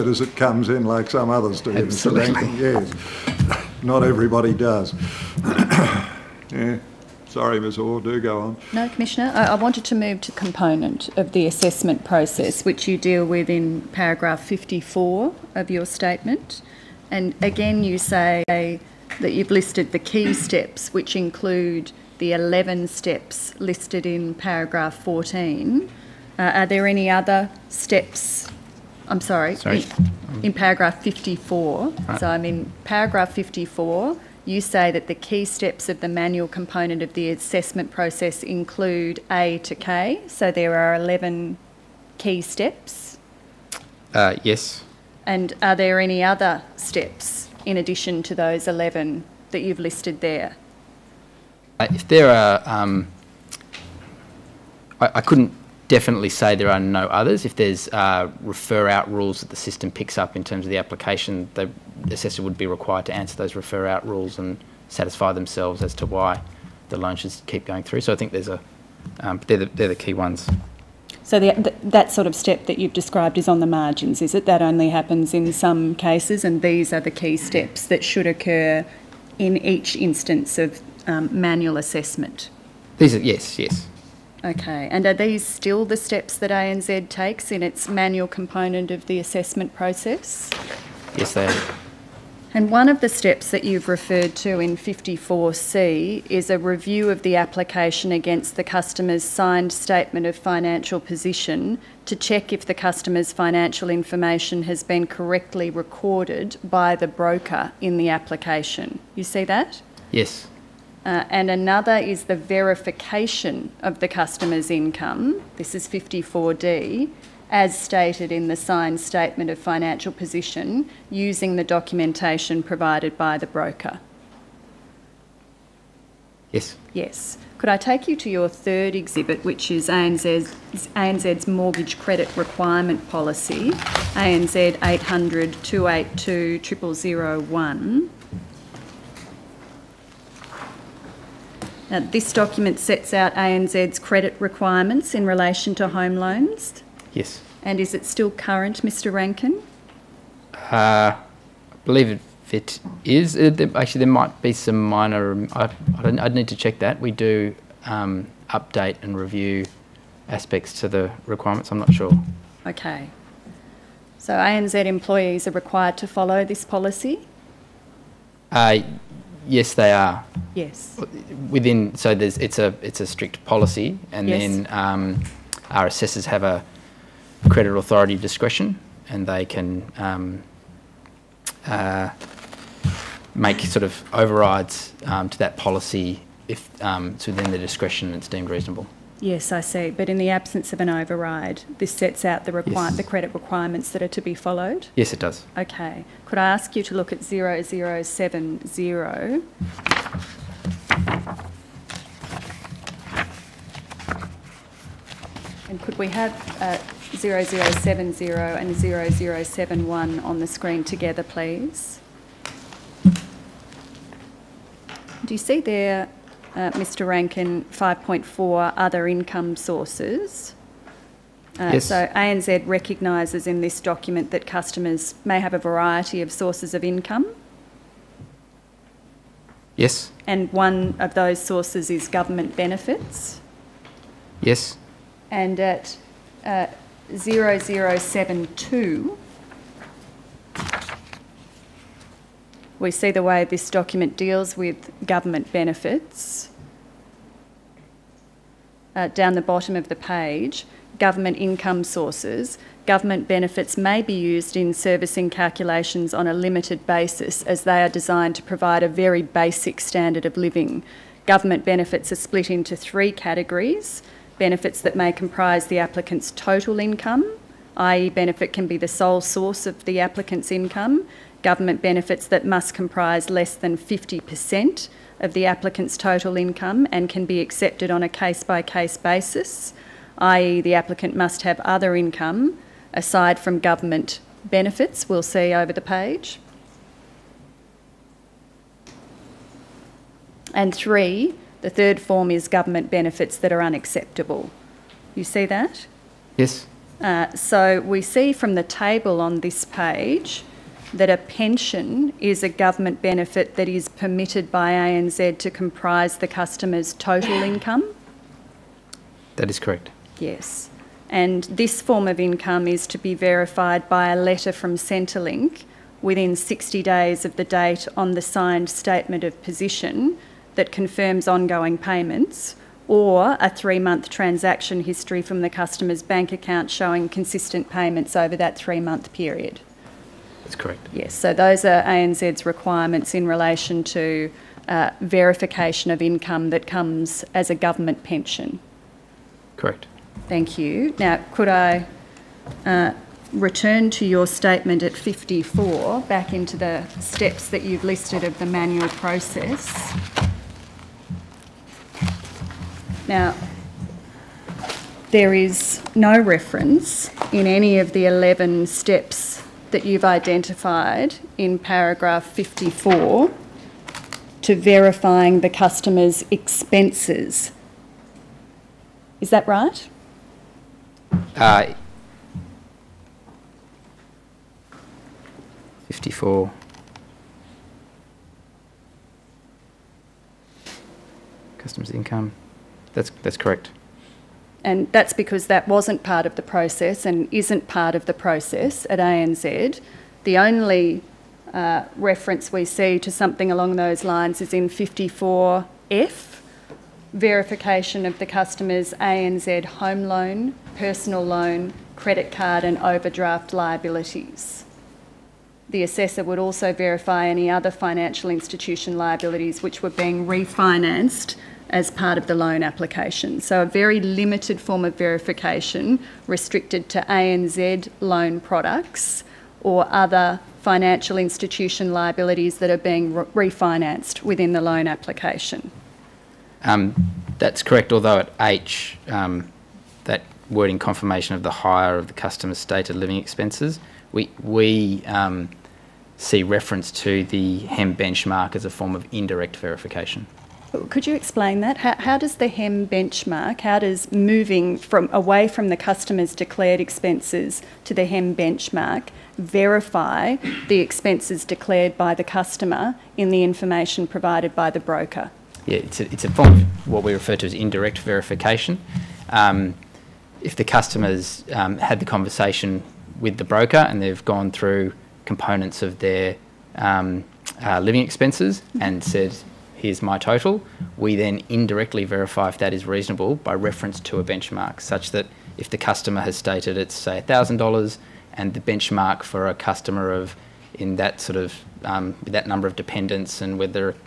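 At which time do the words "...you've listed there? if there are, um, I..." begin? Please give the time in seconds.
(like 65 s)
49 s.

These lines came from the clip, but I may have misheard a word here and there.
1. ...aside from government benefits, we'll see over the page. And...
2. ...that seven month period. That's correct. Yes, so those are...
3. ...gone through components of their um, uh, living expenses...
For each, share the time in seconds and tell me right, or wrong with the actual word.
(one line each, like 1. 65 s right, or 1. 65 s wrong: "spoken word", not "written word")
1. 282 s right
2. 328 s wrong: "three", not "seven"
3. 464 s right.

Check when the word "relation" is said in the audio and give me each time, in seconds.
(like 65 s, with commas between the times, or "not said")
145 s, 333 s.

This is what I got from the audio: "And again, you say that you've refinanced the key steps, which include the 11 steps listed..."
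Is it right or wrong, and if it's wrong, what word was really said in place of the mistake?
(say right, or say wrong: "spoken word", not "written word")
wrong: "listed", not "refinanced".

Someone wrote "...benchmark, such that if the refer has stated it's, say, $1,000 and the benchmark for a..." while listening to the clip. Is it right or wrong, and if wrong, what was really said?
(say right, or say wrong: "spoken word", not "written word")
wrong: "customer", not "refer".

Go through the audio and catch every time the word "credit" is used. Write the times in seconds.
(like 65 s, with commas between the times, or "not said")
131 s, 143 s, 177 s, 193 s, 401 s.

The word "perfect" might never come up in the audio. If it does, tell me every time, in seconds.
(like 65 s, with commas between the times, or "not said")
not said.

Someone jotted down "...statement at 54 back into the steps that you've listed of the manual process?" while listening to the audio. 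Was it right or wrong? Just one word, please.
right.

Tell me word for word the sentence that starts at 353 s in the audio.
Now, there is no reference in any of the 11 steps that you've identified in paragraph 54 to verifying the customer's expenses.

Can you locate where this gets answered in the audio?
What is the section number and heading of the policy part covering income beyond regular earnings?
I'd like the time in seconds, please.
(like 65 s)
217 s.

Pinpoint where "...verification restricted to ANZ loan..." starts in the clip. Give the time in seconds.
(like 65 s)
414 s.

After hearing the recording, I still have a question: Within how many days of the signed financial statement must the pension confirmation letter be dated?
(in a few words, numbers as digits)
60 days.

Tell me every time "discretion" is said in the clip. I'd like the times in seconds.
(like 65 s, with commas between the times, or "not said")
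178 s, 187 s.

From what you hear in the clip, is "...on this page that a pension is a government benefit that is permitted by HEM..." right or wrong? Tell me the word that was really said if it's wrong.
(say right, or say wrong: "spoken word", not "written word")
wrong: "ANZ", not "HEM".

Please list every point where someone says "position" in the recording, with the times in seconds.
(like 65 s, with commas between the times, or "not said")
100 s, 120 s, 319 s.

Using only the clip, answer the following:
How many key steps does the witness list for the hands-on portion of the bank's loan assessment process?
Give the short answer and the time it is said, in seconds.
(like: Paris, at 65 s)
11, at 40 s.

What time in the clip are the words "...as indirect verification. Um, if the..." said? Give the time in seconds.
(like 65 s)
457 s.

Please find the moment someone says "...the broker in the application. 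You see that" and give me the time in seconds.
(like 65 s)
106 s.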